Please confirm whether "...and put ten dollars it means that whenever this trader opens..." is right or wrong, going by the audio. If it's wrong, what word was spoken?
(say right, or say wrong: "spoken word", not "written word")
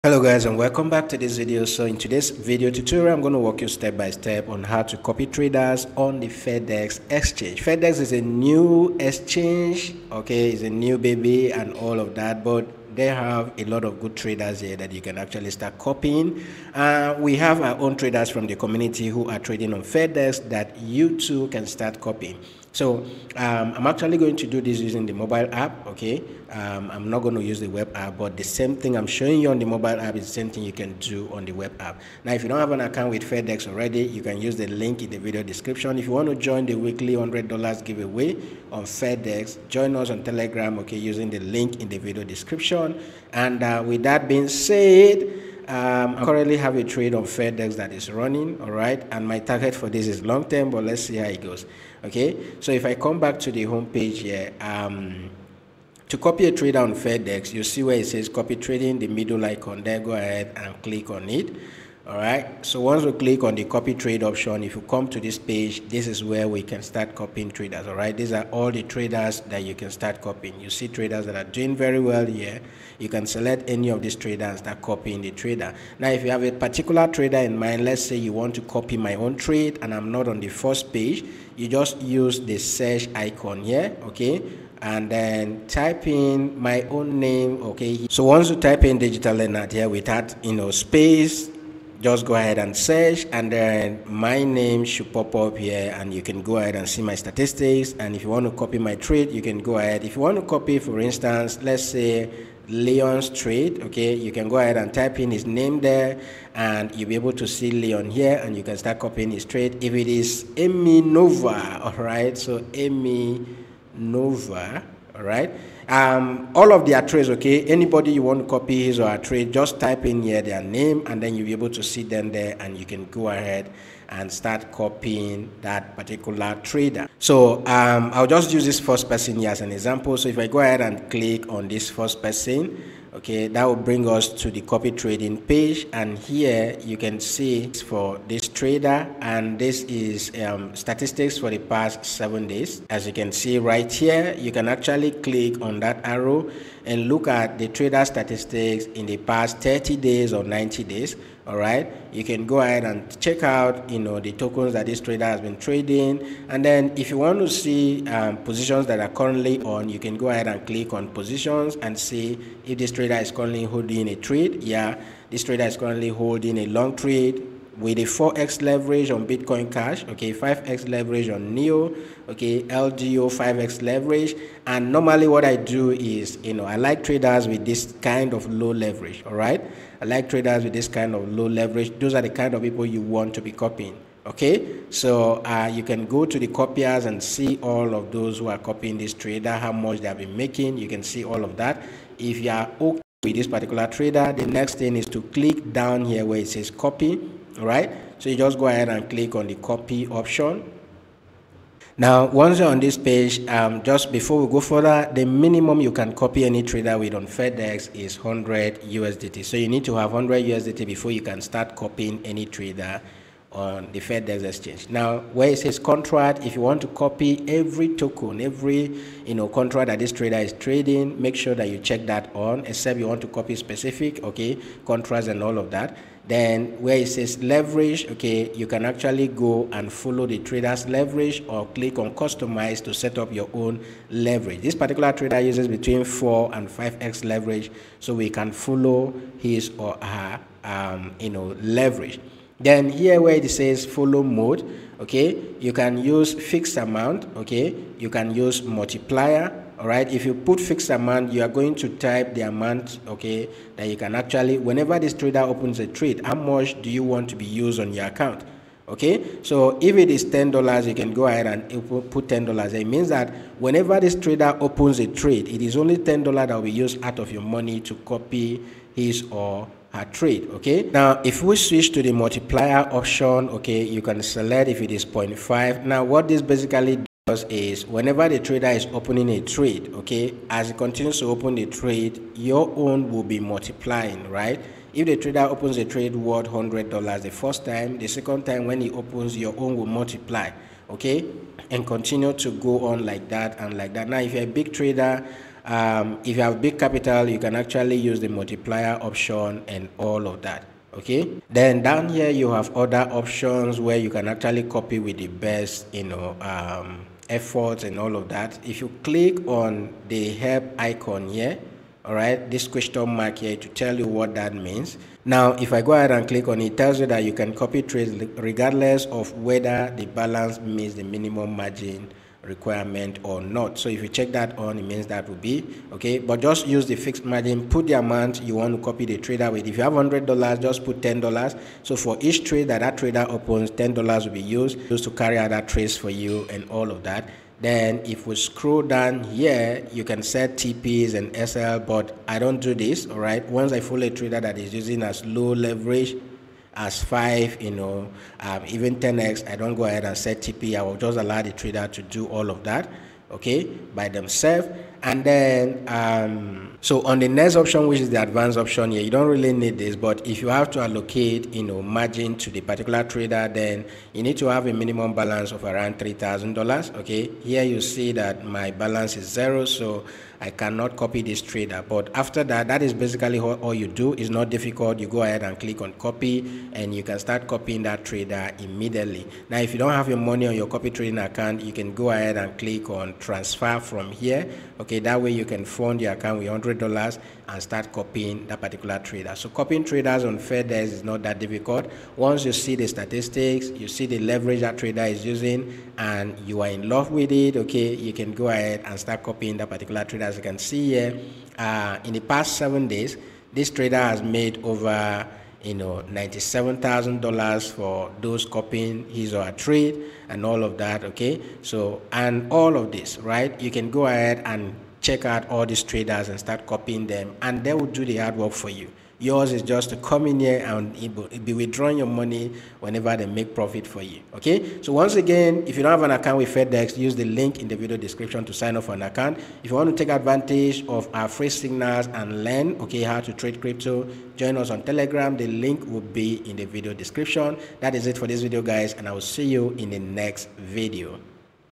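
right.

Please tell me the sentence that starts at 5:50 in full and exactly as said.
I will just allow the trader to do all of that, okay, by themselves.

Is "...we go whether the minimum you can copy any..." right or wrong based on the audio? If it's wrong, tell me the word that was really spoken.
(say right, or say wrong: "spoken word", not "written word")
wrong: "further", not "whether".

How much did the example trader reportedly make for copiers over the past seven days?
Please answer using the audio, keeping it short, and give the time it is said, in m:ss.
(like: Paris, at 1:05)
$97,000, at 6:46.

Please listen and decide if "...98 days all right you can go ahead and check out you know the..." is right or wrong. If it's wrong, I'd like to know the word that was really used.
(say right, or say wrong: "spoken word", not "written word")
wrong: "90", not "98".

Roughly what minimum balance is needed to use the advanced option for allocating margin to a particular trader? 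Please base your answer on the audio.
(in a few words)
$3,000.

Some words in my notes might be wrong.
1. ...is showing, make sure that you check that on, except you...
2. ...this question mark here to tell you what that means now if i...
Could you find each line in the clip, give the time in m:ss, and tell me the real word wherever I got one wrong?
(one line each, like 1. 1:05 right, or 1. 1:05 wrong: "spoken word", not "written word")
1. 3:40 wrong: "trading", not "showing"
2. 5:12 right.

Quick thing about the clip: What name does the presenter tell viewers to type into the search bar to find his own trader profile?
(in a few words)
digital leonard.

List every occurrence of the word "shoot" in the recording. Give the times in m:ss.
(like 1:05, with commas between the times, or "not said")
not said.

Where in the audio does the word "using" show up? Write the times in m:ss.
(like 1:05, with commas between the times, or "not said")
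0:24, 0:40, 5:44, 6:35.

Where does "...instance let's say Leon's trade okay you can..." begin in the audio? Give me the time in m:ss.
1:40.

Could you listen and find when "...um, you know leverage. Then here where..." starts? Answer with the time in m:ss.
4:00.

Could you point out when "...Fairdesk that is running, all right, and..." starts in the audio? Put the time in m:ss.
0:47.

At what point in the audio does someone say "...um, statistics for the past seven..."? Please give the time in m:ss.
2:20.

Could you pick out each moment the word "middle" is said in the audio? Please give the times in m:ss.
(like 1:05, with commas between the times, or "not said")
0:59.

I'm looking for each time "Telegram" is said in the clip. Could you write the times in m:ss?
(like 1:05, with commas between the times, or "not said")
0:40, 7:14.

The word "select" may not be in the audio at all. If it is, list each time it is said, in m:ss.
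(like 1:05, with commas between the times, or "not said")
1:13, 4:34.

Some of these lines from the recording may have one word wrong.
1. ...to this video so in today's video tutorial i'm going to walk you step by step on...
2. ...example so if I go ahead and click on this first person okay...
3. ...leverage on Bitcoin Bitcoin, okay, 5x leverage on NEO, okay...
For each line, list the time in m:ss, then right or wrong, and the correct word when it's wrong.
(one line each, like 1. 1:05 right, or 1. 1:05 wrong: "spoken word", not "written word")
1. 0:01 right
2. 2:09 right
3. 2:48 wrong: "Cash", not "Bitcoin".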